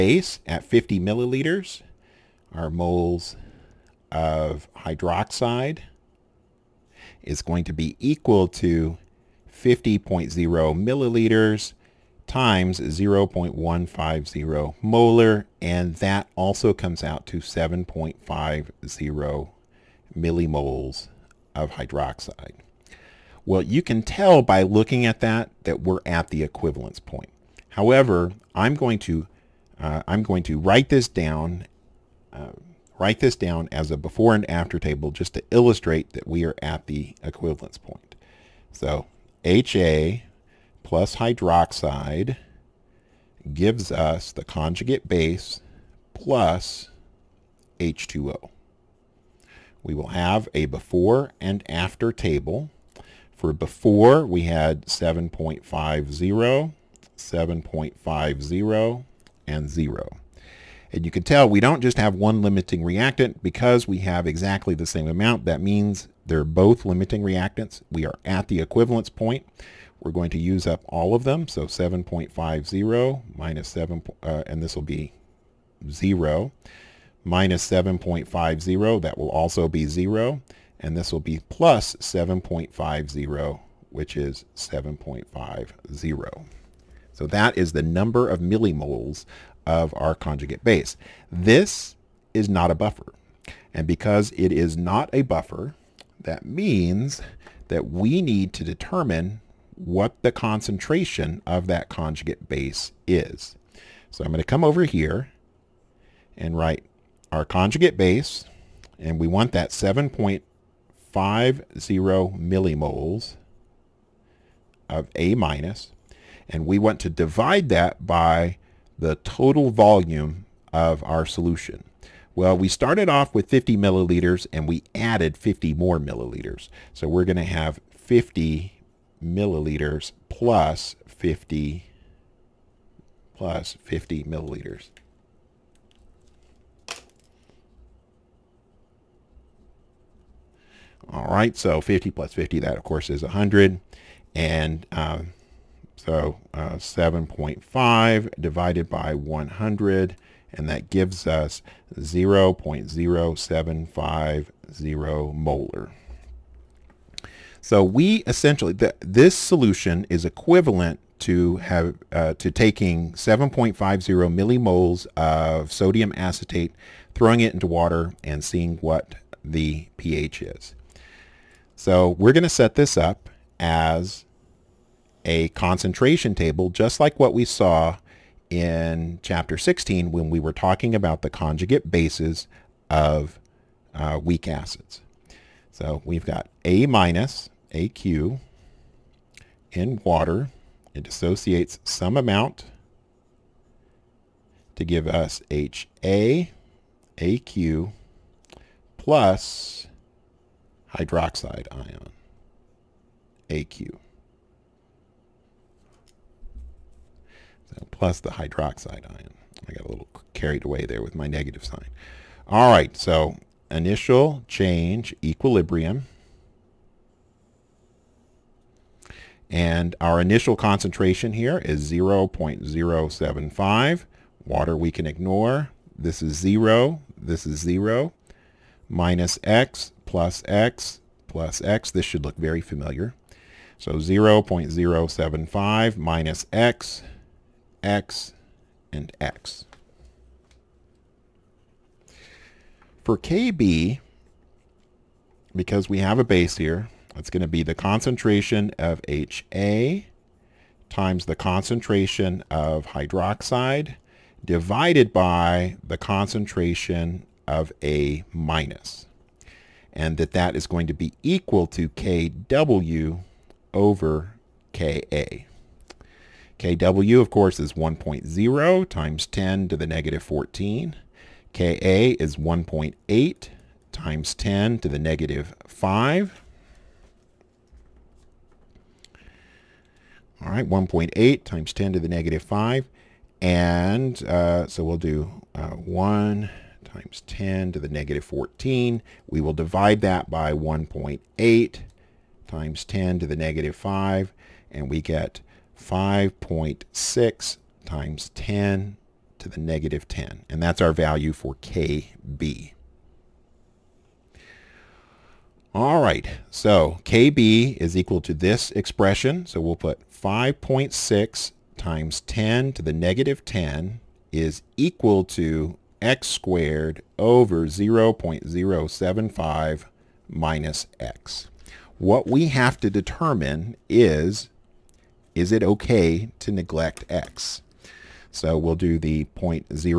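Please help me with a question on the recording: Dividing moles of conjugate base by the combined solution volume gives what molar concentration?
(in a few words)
0.0750 molar.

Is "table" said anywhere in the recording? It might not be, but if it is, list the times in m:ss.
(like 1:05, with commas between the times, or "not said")
0:34, 0:52, 2:56.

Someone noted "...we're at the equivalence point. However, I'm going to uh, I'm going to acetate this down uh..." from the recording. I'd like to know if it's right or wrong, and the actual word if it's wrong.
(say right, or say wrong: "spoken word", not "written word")
wrong: "write", not "acetate".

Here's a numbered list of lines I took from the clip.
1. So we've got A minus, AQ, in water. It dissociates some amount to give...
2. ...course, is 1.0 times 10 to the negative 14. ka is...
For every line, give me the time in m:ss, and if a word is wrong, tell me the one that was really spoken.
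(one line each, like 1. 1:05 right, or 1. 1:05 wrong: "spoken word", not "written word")
1. 3:05 right
2. 4:27 right.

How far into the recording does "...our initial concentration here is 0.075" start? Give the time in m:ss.
3:40.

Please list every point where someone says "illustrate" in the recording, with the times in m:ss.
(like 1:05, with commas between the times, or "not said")
0:35.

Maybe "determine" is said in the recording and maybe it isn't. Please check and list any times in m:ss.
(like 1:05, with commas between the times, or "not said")
1:38, 5:22.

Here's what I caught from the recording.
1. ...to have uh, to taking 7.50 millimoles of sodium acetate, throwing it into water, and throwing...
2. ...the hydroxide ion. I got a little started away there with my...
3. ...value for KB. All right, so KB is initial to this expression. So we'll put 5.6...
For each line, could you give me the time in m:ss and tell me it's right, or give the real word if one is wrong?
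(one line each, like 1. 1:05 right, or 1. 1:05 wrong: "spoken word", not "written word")
1. 2:41 wrong: "seeing", not "throwing"
2. 3:28 wrong: "carried", not "started"
3. 5:00 wrong: "equal", not "initial".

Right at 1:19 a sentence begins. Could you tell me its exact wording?
That will also be 0 and this will be plus 7.50, which is 7.50.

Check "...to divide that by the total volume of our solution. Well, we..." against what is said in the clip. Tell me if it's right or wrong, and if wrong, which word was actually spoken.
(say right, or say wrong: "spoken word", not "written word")
right.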